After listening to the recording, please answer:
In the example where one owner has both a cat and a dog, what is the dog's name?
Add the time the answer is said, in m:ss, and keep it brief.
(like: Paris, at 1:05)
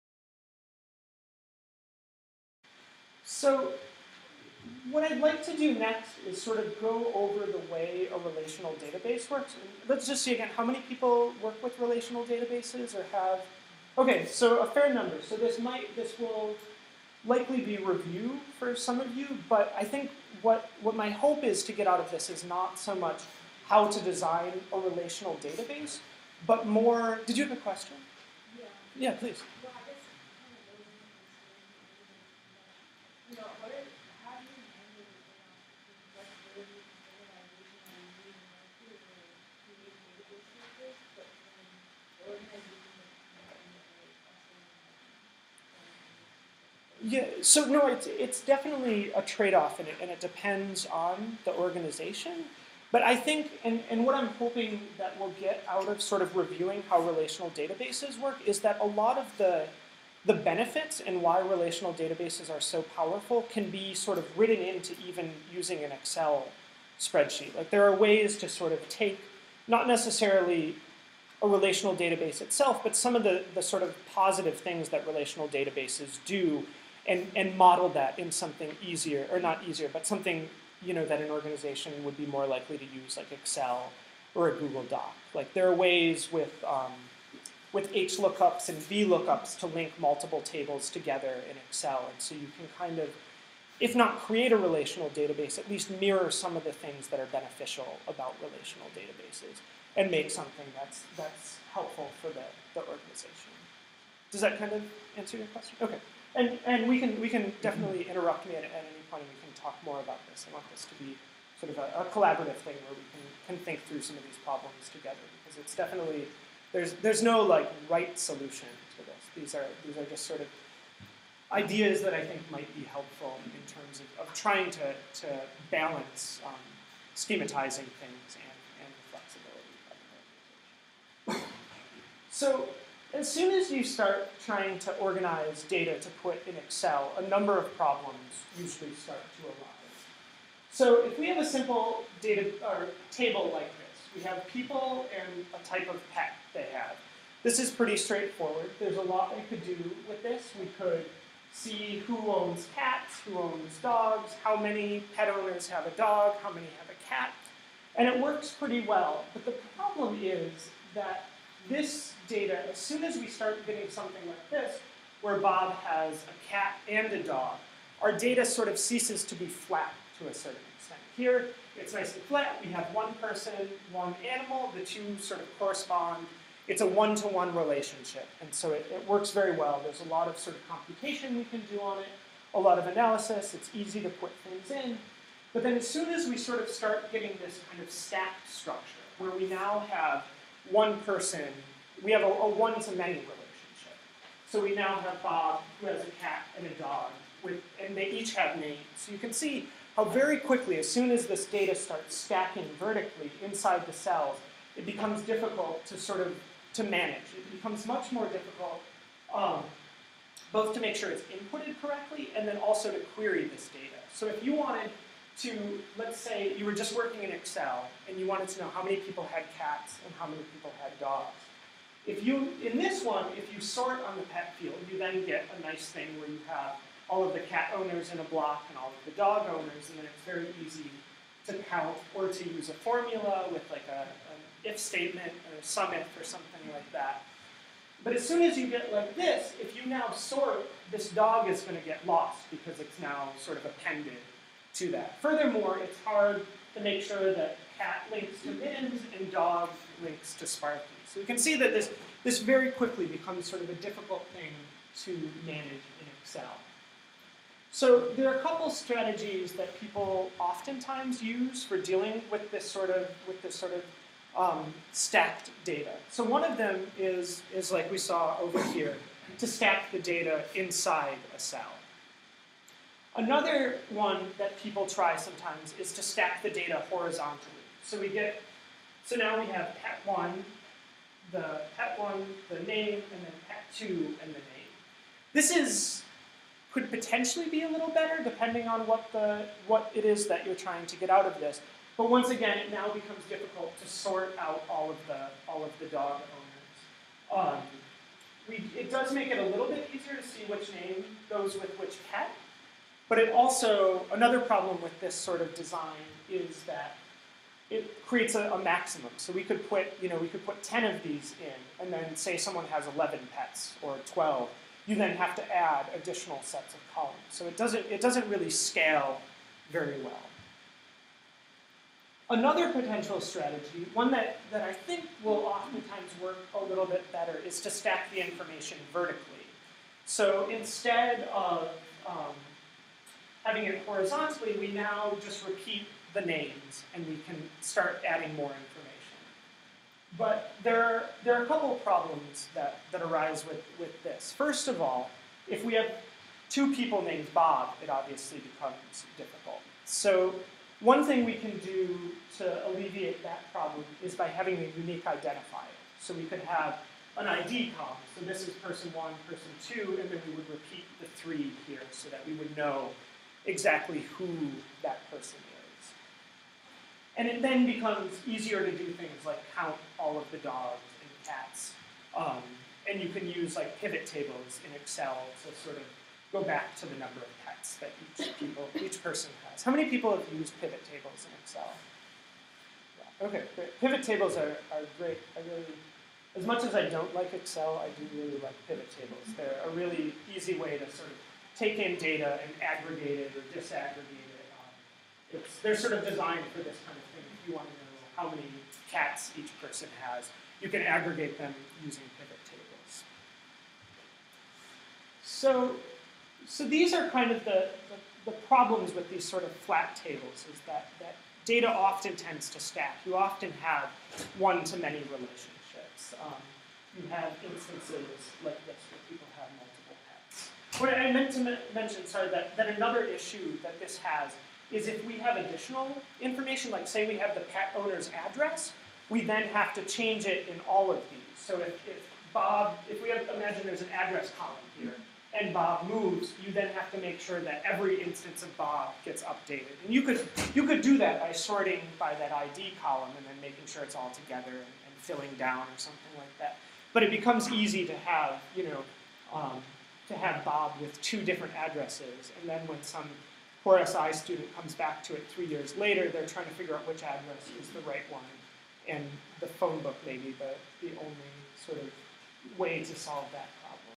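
Sparky, at 4:10.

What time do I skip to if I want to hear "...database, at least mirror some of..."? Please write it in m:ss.
1:35.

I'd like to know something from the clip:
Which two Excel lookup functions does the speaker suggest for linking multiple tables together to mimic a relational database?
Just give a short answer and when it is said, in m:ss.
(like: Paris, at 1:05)
H lookups and V lookups, at 1:27.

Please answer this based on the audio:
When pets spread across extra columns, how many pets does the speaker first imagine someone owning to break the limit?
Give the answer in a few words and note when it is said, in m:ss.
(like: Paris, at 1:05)
11, at 5:12.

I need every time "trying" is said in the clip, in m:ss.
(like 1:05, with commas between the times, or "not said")
2:04, 2:14, 4:50, 7:36.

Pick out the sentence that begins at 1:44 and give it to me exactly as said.
Does that kind of answer your question?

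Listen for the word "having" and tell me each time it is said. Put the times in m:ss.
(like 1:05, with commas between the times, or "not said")
5:33, 5:54.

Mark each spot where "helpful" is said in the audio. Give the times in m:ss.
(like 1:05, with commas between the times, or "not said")
1:41, 2:02.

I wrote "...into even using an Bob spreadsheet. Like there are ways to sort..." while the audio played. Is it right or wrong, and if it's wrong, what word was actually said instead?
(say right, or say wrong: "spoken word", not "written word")
wrong: "Excel", not "Bob".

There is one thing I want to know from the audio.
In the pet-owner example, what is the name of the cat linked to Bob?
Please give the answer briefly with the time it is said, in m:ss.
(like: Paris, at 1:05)
Bins, at 4:08.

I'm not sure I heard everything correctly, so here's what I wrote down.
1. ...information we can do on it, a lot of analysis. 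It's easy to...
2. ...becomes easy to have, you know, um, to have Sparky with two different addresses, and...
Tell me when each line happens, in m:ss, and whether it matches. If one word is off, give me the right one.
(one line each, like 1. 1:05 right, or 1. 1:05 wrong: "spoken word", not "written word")
1. 3:00 wrong: "computation", not "information"
2. 7:27 wrong: "Bob", not "Sparky".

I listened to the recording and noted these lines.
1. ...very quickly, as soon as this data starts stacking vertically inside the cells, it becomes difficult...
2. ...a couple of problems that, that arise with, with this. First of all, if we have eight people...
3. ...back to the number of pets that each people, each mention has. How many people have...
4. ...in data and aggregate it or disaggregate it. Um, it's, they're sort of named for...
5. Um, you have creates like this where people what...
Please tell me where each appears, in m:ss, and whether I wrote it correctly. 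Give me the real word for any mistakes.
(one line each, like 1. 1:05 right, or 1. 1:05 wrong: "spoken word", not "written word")
1. 3:20 right
2. 5:41 wrong: "two", not "eight"
3. 6:16 wrong: "person", not "mention"
4. 6:31 wrong: "designed", not "named"
5. 6:56 wrong: "instances", not "creates".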